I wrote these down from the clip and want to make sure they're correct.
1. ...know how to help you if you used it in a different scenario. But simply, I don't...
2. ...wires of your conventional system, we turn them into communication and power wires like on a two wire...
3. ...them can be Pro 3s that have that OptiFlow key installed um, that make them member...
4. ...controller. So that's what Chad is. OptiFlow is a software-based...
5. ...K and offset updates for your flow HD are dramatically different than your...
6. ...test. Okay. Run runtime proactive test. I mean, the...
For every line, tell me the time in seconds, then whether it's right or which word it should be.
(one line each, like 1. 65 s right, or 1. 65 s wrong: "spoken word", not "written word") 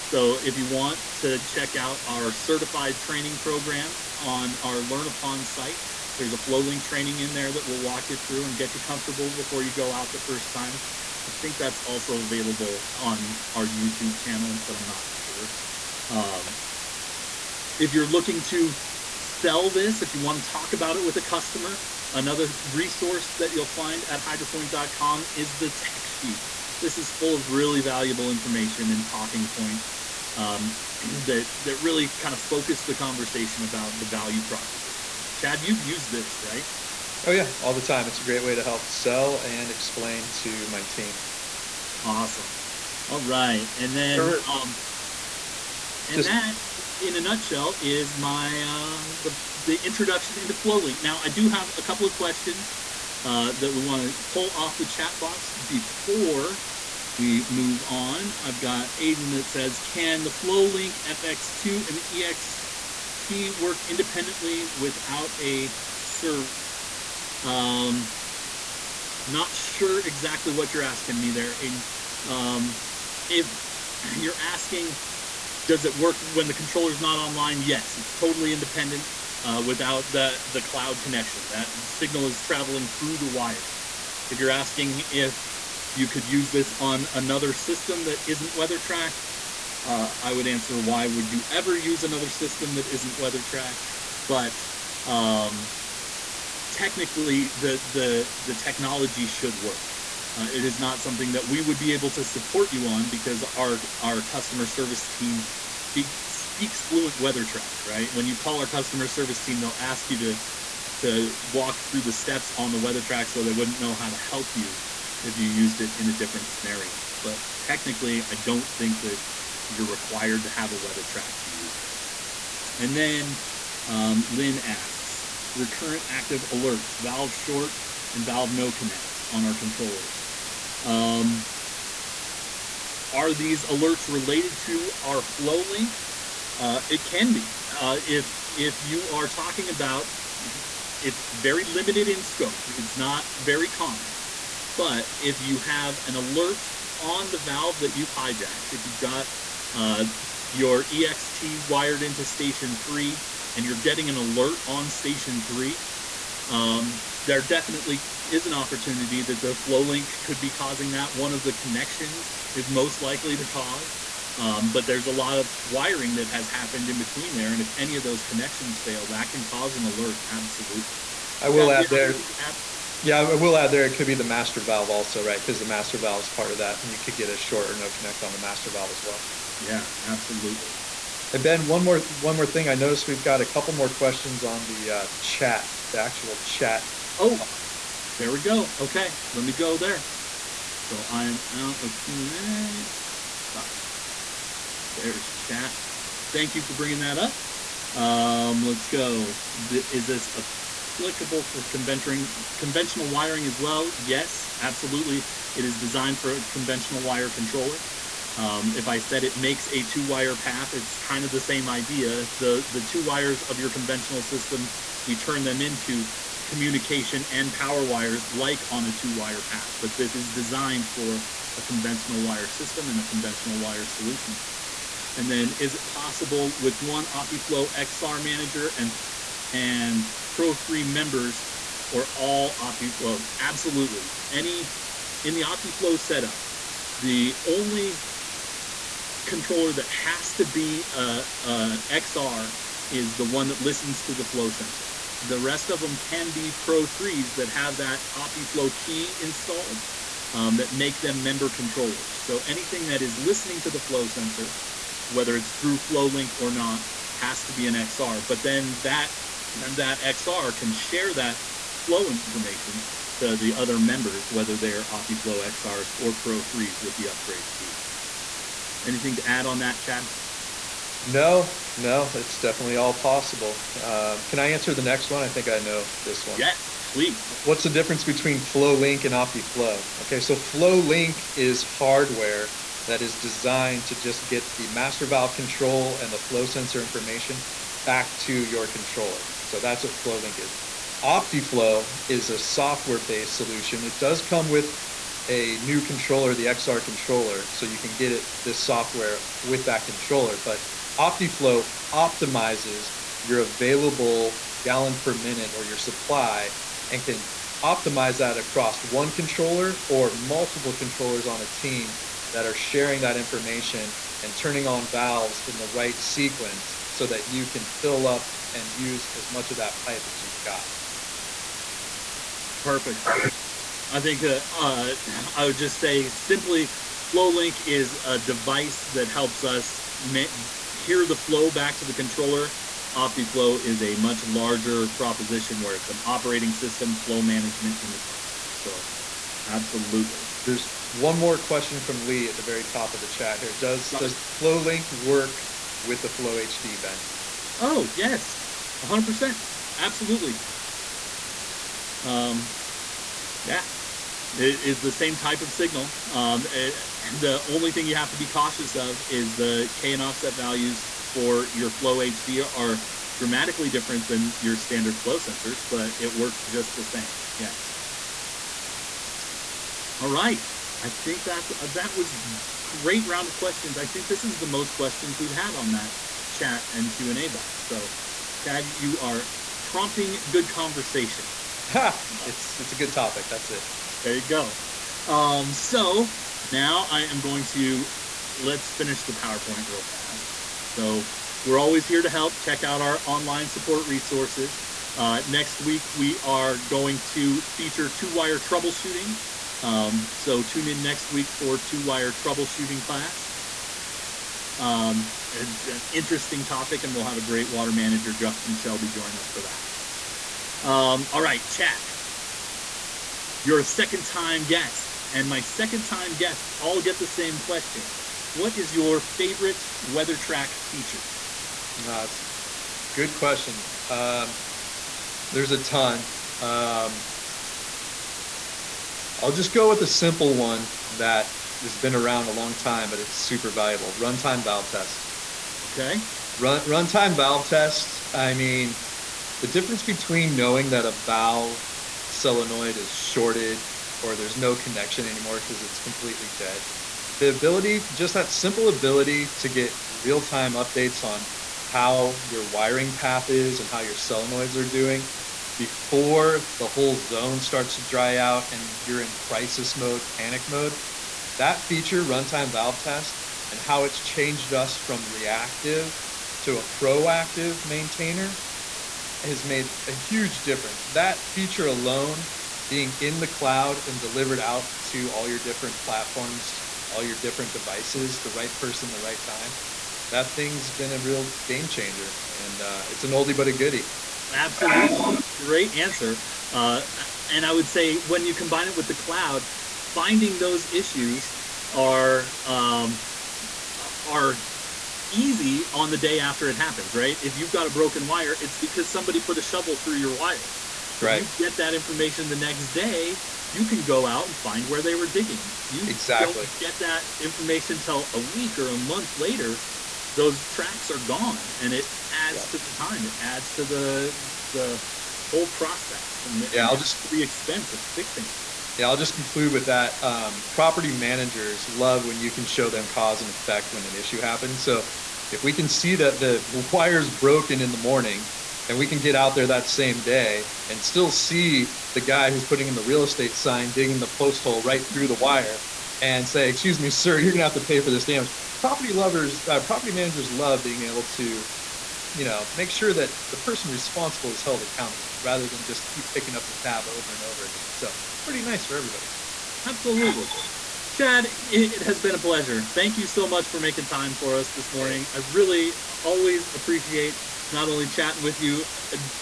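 1. 113 s wrong: "technically", not "simply"
2. 213 s right
3. 245 s right
4. 288 s wrong: "FlowLink", not "Chad"
5. 359 s wrong: "values", not "updates"
6. 434 s wrong: "valve", not "proactive".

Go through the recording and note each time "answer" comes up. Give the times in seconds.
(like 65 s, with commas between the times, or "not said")
90 s, 274 s, 485 s.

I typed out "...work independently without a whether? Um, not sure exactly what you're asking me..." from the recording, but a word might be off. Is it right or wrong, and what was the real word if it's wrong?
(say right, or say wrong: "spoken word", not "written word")
wrong: "server", not "whether".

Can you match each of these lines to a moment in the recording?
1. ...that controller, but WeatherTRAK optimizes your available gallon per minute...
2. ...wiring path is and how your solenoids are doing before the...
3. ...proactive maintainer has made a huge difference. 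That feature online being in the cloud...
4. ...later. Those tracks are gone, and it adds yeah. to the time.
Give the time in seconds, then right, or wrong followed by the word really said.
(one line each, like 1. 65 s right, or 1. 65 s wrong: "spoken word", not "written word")
1. 299 s wrong: "OptiFlow", not "WeatherTRAK"
2. 452 s right
3. 466 s wrong: "alone", not "online"
4. 509 s right.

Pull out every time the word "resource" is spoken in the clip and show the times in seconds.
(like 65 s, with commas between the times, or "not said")
22 s, 393 s.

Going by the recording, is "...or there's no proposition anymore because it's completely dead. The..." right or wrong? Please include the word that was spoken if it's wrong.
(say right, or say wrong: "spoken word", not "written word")
wrong: "connection", not "proposition".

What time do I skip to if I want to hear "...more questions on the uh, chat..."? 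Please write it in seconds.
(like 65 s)
183 s.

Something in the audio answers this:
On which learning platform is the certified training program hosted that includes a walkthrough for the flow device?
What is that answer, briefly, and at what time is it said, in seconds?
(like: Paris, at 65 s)
LearnUpon, at 4 s.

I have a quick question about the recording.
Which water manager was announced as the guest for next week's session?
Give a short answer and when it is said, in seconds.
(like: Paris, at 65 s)
Justin Shelby, at 408 s.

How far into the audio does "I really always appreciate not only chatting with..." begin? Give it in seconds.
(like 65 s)
555 s.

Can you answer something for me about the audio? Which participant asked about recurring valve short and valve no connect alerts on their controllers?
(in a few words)
Lynn.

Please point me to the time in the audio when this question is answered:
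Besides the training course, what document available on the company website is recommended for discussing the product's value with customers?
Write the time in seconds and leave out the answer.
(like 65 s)
25 s.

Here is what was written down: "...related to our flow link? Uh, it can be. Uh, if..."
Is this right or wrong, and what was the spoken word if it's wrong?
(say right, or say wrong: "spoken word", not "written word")
right.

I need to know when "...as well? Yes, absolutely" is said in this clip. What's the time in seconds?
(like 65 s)
203 s.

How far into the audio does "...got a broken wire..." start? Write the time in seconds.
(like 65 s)
497 s.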